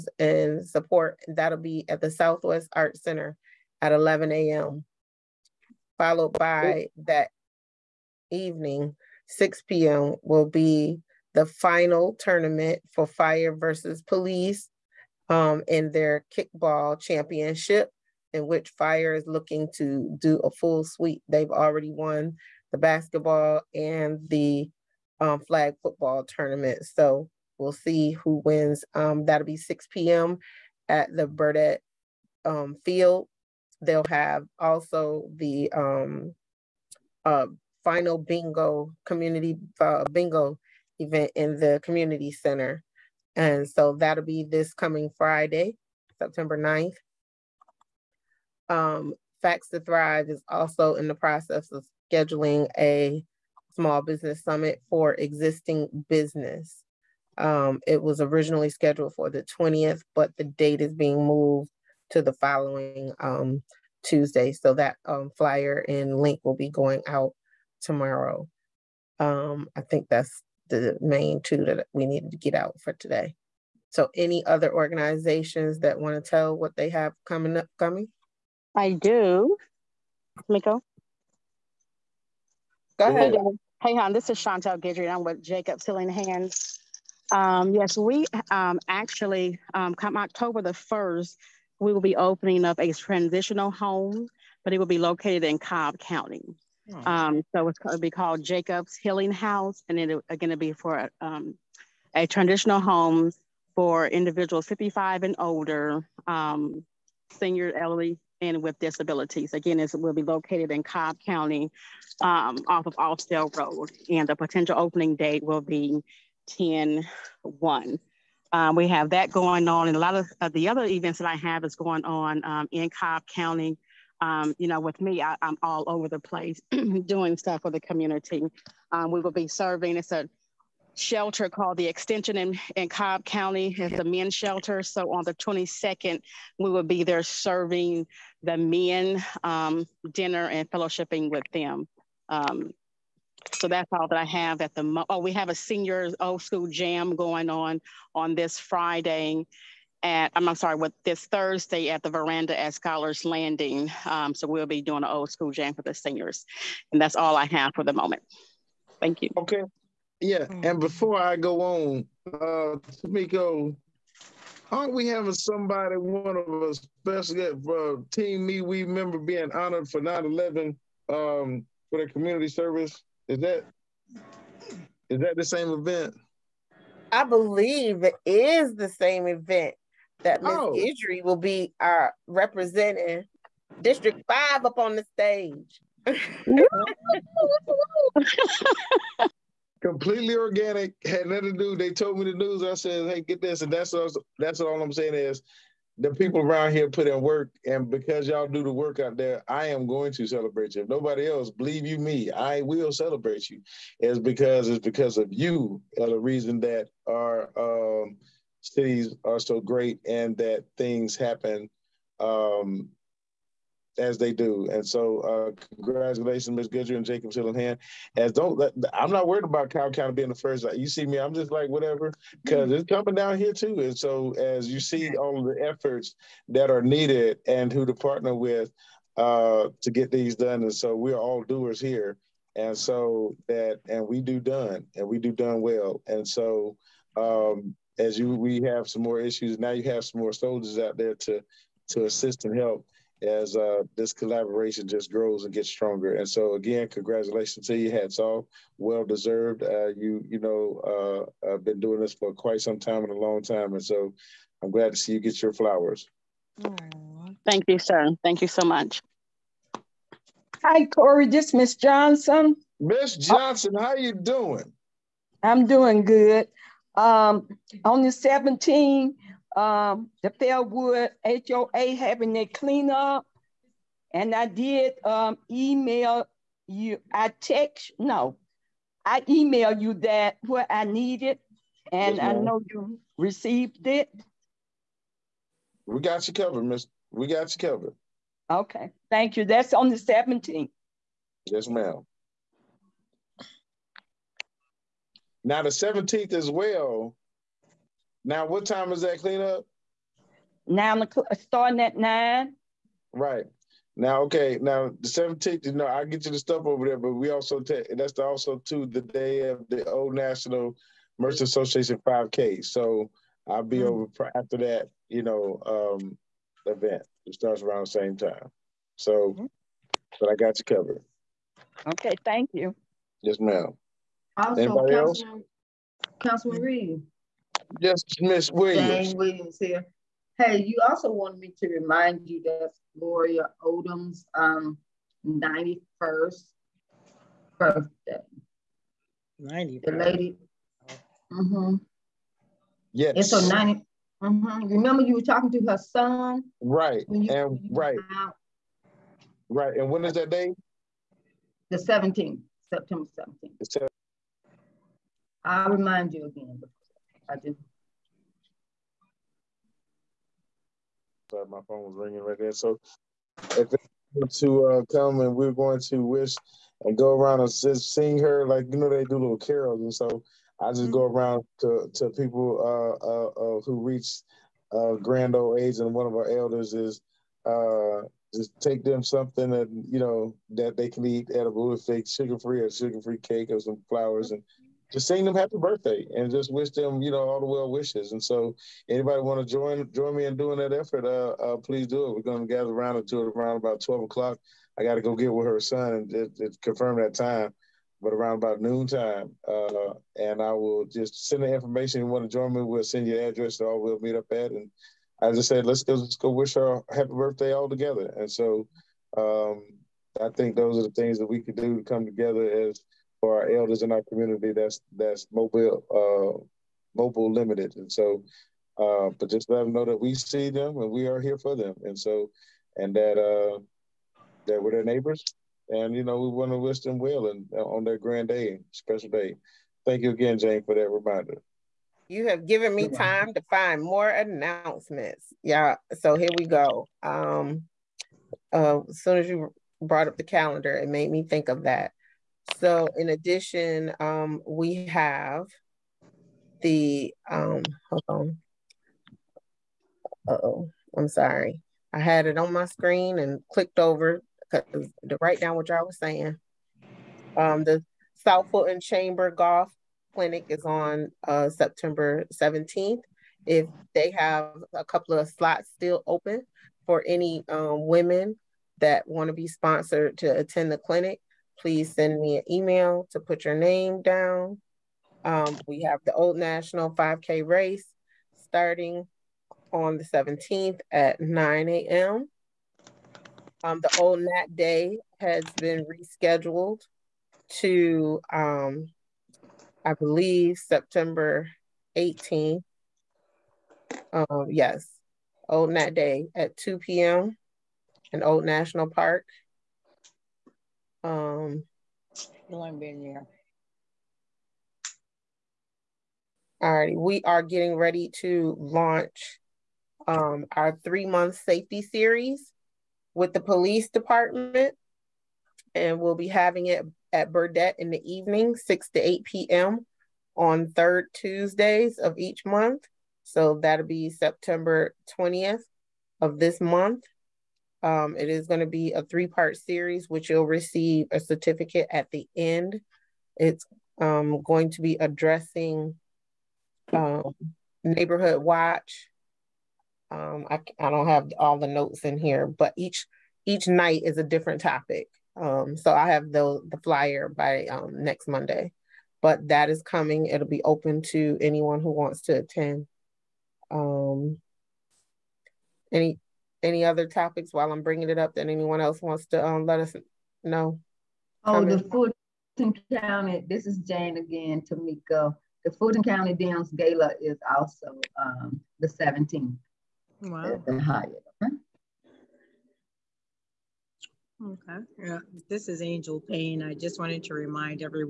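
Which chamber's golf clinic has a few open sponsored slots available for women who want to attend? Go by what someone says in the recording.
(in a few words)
South Fulton Chamber.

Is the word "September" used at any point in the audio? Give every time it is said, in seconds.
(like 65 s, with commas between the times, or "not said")
46 s, 352 s, 461 s, 490 s, 524 s.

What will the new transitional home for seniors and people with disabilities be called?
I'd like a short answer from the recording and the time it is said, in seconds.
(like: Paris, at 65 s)
Jacob's Healing House, at 98 s.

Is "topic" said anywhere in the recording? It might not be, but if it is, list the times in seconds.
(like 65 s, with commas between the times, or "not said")
544 s, 557 s.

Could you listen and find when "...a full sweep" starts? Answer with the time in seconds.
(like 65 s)
20 s.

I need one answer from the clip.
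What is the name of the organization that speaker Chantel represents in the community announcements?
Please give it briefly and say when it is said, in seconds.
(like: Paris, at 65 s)
Jacobs Healing Hands, at 85 s.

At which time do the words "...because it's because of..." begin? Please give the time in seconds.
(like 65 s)
204 s.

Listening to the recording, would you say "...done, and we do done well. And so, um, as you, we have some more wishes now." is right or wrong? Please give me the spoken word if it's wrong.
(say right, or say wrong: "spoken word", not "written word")
wrong: "issues", not "wishes".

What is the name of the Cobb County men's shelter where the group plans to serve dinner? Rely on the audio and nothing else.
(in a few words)
The Extension.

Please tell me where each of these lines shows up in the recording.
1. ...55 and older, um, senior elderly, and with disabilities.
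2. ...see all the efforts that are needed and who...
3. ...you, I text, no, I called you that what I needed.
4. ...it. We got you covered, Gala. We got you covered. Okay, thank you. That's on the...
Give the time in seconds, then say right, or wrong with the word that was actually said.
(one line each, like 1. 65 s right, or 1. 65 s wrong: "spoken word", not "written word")
1. 104 s right
2. 224 s right
3. 276 s wrong: "emailed", not "called"
4. 283 s wrong: "Miss", not "Gala".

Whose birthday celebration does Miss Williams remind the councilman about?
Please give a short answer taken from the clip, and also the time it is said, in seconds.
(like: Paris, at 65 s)
Gloria Odom, at 332 s.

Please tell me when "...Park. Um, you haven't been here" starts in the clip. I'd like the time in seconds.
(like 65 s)
498 s.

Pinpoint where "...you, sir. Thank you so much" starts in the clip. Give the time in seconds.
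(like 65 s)
257 s.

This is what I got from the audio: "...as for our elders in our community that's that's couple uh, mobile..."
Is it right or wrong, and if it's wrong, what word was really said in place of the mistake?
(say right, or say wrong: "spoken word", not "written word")
wrong: "mobile", not "couple".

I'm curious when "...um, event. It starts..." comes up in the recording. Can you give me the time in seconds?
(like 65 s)
315 s.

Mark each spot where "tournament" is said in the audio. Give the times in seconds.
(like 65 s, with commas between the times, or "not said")
12 s, 26 s.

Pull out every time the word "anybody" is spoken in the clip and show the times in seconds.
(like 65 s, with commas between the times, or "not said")
324 s, 388 s.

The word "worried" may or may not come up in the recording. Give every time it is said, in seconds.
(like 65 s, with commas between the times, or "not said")
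219 s.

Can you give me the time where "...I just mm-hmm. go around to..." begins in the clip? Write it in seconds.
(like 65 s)
370 s.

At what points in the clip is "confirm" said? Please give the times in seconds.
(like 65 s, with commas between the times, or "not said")
396 s.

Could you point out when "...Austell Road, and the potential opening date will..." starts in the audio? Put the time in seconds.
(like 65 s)
112 s.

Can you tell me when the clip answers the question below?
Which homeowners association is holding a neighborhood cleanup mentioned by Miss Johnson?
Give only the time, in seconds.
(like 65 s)
270 s.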